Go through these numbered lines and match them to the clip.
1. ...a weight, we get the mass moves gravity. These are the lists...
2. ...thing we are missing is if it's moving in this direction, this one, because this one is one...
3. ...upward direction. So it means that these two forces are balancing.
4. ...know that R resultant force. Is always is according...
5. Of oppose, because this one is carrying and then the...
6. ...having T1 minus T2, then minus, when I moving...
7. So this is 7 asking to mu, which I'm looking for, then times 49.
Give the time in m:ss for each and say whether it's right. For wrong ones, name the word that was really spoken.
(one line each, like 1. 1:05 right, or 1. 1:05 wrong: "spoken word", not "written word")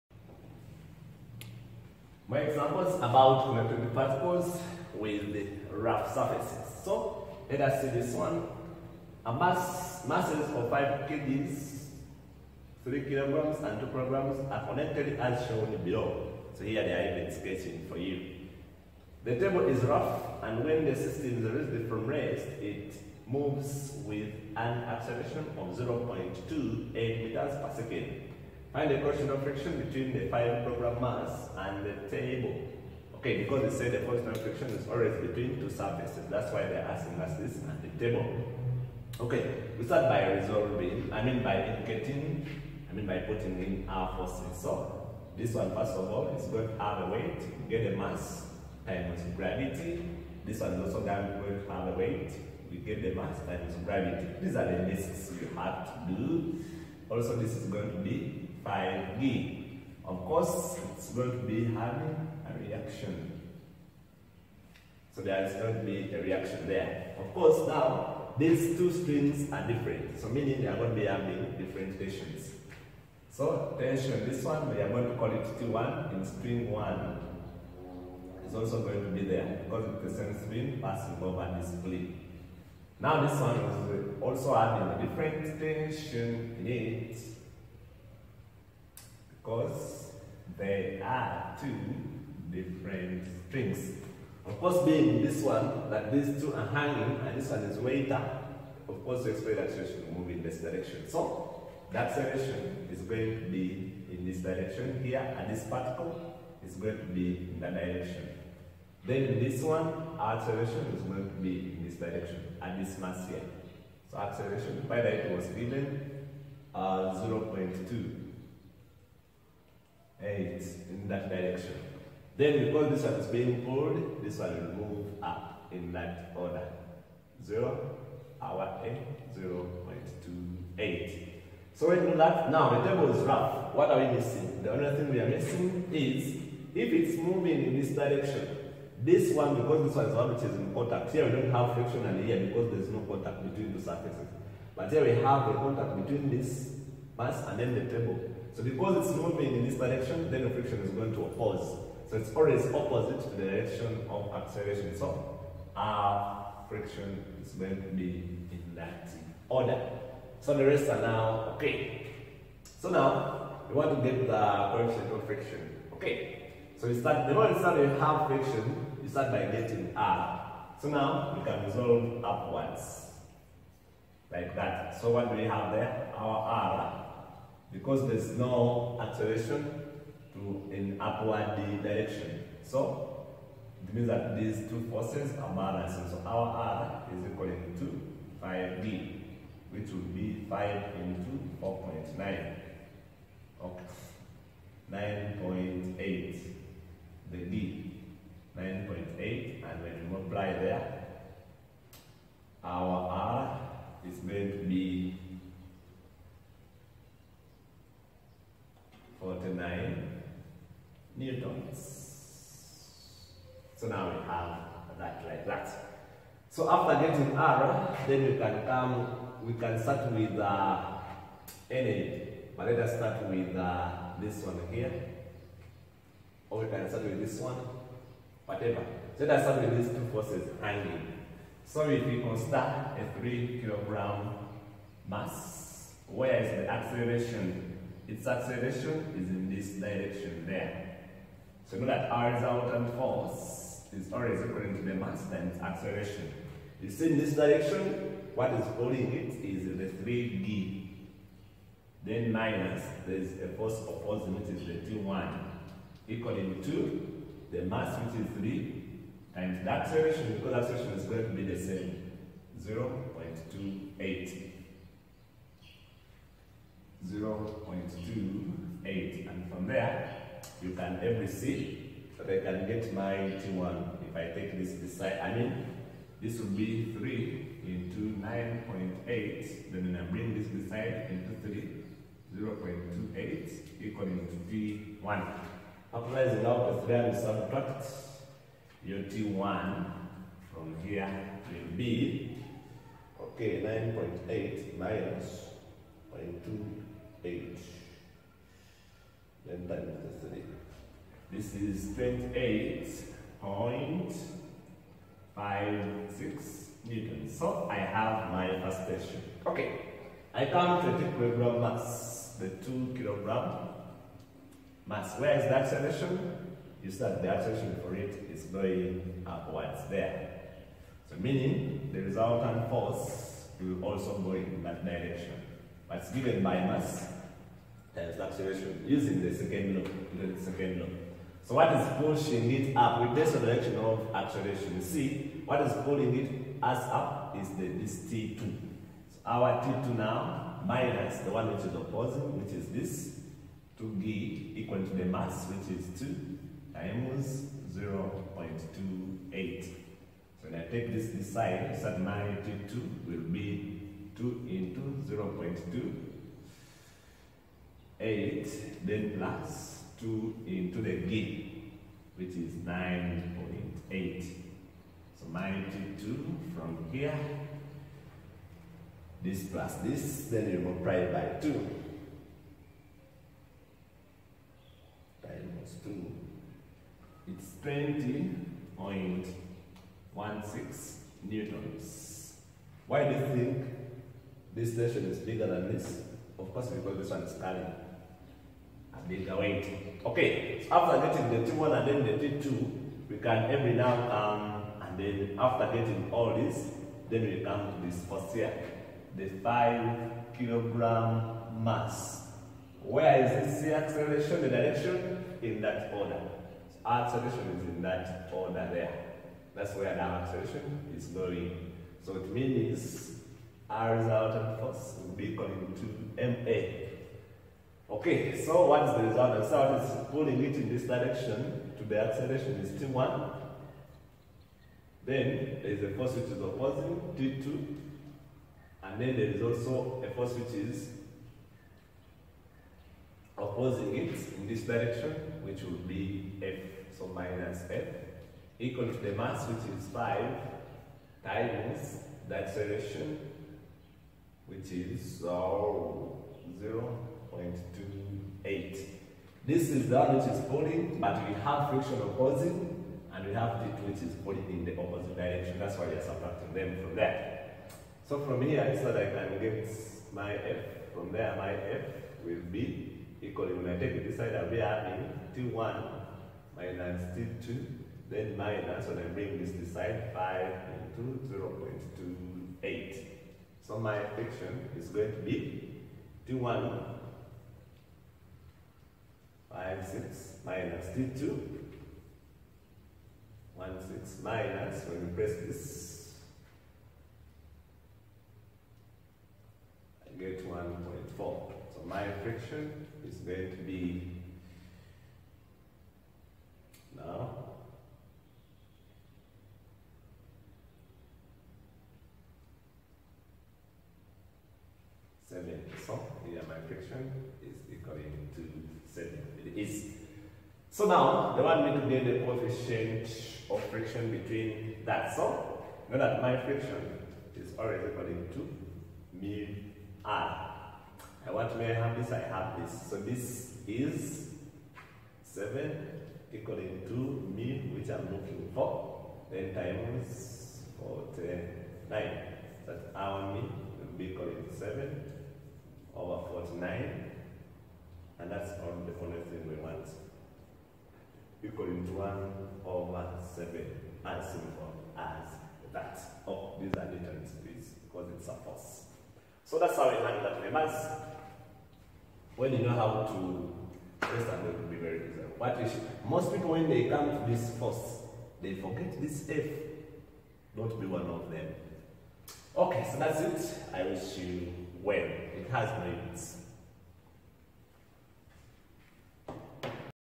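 1. 0:51 wrong: "times", not "moves"
2. 2:14 right
3. 3:00 right
4. 4:01 right
5. 6:26 wrong: "course", not "oppose"
6. 7:44 wrong: "bring", not "moving"
7. 8:42 wrong: "equaling", not "asking".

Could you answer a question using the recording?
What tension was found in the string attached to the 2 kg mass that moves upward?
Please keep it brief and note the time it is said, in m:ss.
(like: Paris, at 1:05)
20.16 newtons, at 6:17.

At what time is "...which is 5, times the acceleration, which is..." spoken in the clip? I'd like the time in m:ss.
7:19.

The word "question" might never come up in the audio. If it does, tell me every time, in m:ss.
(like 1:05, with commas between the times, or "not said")
0:28, 5:08.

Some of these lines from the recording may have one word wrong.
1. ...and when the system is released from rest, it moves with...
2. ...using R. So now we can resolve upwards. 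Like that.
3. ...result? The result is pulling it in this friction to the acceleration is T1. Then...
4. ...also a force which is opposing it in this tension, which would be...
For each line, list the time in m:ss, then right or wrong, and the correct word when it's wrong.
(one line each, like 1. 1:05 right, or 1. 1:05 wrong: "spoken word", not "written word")
1. 0:20 right
2. 2:49 wrong: "getting", not "using"
3. 6:59 wrong: "direction", not "friction"
4. 7:09 wrong: "direction", not "tension".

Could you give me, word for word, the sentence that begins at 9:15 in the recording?
What is, most people, when they come to this force, they forget this F.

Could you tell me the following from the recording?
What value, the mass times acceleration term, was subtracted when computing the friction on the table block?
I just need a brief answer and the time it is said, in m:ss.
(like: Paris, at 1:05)
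1.4, at 8:10.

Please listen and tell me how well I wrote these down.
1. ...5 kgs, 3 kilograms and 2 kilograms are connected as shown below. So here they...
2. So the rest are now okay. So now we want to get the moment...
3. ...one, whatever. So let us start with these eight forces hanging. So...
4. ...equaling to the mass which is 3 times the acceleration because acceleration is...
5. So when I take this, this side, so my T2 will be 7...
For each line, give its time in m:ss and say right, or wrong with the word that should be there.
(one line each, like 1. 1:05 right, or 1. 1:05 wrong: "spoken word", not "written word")
1. 0:10 right
2. 2:40 wrong: "coefficient", not "moment"
3. 3:47 wrong: "two", not "eight"
4. 4:16 right
5. 5:49 wrong: "2", not "7".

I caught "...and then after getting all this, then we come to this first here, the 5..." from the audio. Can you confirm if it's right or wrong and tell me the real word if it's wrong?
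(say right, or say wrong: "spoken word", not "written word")
right.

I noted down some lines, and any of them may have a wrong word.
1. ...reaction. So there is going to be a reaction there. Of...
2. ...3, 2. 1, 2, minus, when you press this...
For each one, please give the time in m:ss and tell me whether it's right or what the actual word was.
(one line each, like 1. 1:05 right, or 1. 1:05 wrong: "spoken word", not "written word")
1. 1:02 right
2. 8:00 wrong: "6", not "2".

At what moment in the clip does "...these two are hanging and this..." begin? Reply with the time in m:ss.
1:36.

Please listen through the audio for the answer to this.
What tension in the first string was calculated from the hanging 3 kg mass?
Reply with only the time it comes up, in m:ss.
5:01.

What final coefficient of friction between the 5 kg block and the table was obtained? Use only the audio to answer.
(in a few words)
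1/7.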